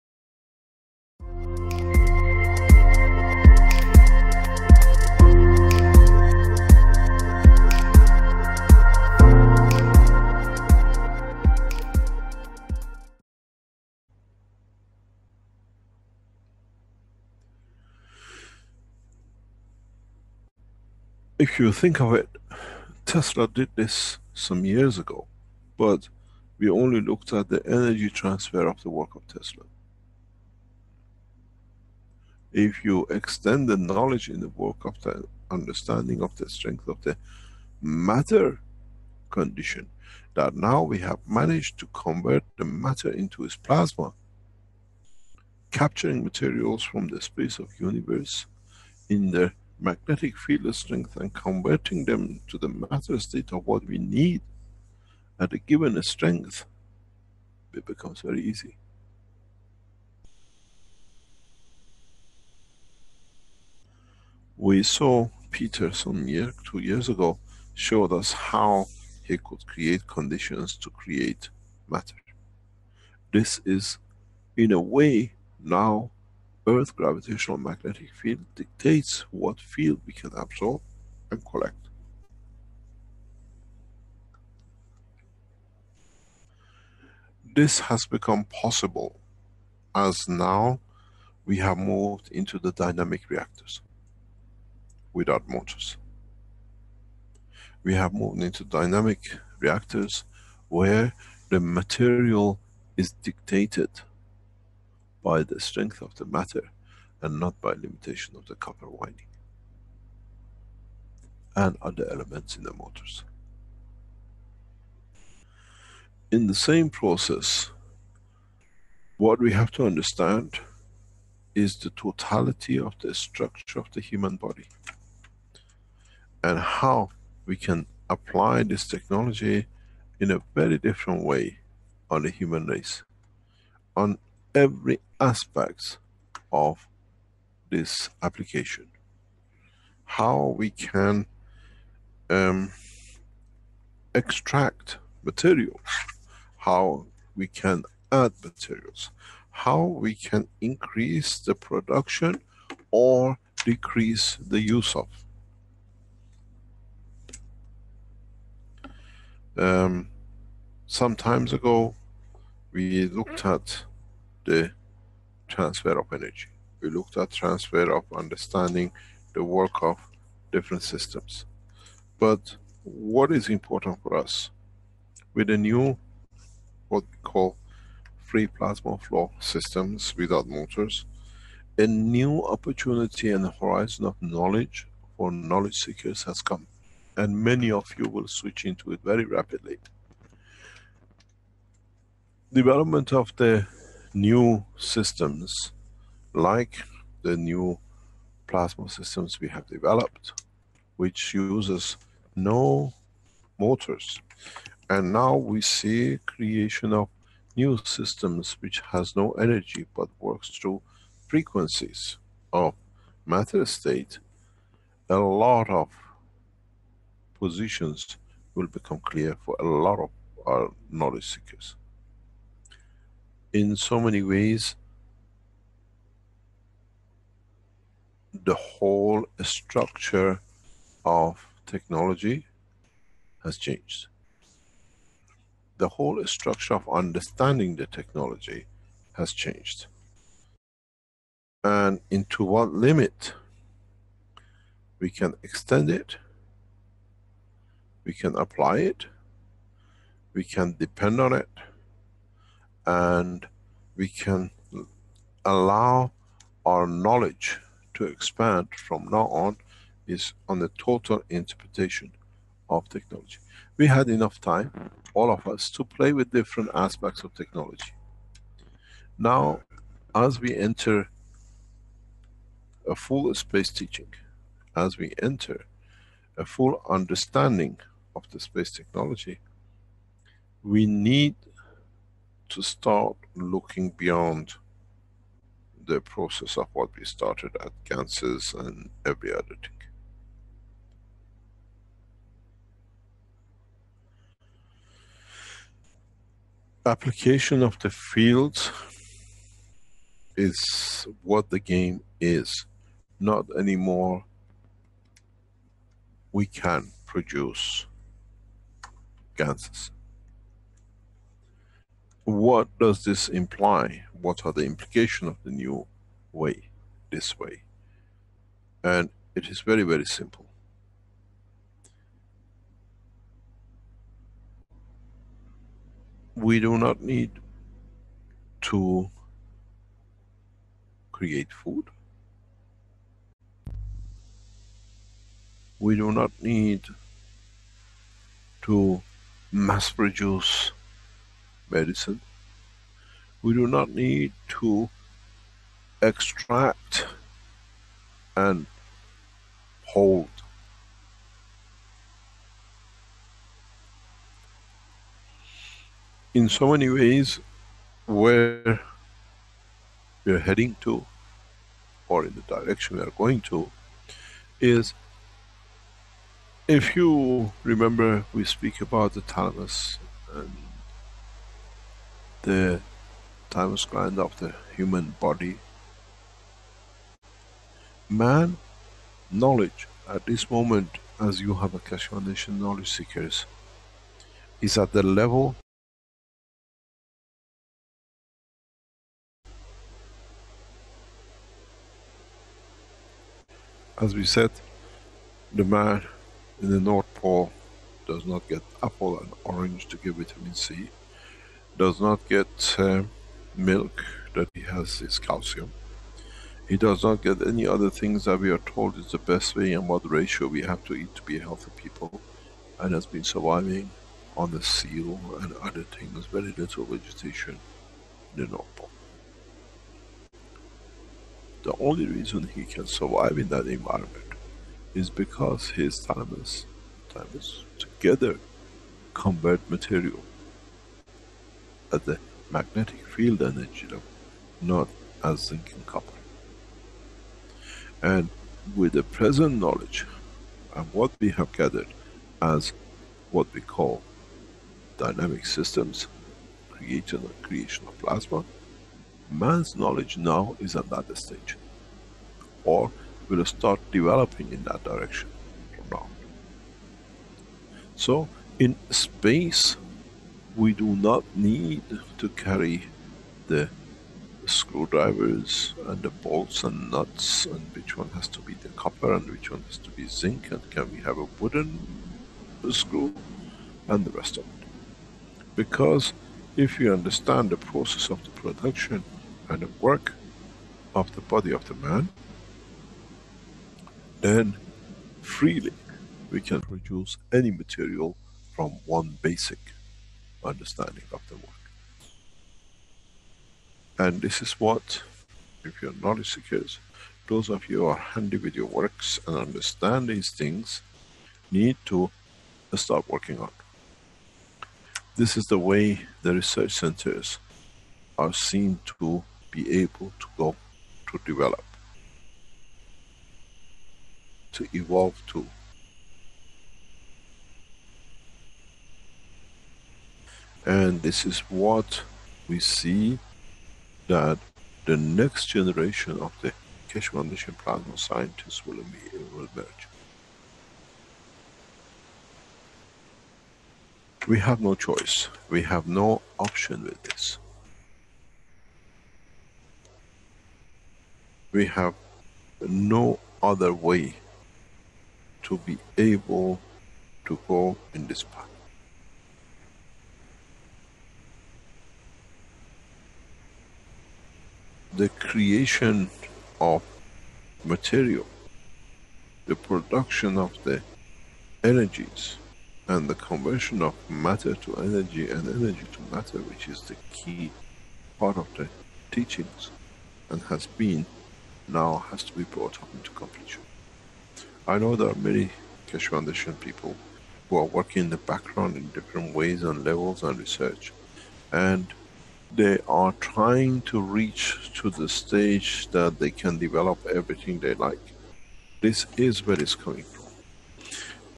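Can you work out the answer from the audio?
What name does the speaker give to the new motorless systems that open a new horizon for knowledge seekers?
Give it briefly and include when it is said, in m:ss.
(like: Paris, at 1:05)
free plasma flow systems, at 2:58.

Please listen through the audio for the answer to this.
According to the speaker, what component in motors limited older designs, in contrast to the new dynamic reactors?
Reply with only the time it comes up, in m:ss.
1:48.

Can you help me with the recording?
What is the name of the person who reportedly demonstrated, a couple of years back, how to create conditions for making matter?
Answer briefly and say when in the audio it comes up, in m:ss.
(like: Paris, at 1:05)
Peter, at 1:05.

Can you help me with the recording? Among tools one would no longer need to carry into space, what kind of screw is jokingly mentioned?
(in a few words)
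wooden screw.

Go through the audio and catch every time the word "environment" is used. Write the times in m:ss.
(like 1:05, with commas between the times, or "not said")
7:03.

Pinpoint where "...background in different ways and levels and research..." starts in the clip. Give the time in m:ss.
9:38.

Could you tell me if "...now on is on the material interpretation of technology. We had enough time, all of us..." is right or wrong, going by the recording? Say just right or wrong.
wrong.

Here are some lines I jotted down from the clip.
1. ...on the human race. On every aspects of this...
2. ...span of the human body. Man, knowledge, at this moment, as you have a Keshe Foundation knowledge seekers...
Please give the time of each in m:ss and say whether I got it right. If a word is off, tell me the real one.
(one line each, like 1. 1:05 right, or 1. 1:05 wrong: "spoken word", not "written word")
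1. 2:12 right
2. 6:13 right.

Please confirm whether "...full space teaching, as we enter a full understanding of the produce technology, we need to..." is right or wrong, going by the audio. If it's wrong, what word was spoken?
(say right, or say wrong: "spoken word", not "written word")
wrong: "space", not "produce".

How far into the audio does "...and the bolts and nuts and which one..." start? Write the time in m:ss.
7:45.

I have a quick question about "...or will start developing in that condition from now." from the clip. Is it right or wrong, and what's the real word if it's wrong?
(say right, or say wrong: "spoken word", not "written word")
wrong: "direction", not "condition".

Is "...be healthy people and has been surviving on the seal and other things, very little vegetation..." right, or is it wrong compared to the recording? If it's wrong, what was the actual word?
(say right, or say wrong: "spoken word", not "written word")
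right.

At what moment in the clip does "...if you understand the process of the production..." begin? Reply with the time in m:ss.
7:56.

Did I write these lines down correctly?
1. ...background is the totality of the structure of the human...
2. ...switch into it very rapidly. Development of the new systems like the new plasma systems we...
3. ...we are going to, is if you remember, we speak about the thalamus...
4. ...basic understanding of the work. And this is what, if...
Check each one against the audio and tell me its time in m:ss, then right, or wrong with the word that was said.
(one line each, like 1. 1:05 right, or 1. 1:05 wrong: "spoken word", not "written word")
1. 1:59 wrong: "understand", not "background"
2. 3:08 right
3. 6:02 right
4. 8:09 right.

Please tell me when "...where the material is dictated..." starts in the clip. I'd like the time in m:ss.
1:40.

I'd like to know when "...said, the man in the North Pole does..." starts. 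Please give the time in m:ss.
6:34.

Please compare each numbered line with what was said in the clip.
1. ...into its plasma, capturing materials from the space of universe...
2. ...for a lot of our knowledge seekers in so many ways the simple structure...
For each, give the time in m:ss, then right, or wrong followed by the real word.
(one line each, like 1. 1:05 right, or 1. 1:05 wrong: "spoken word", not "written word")
1. 0:43 right
2. 3:39 wrong: "whole", not "simple".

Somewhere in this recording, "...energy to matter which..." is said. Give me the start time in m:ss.
9:25.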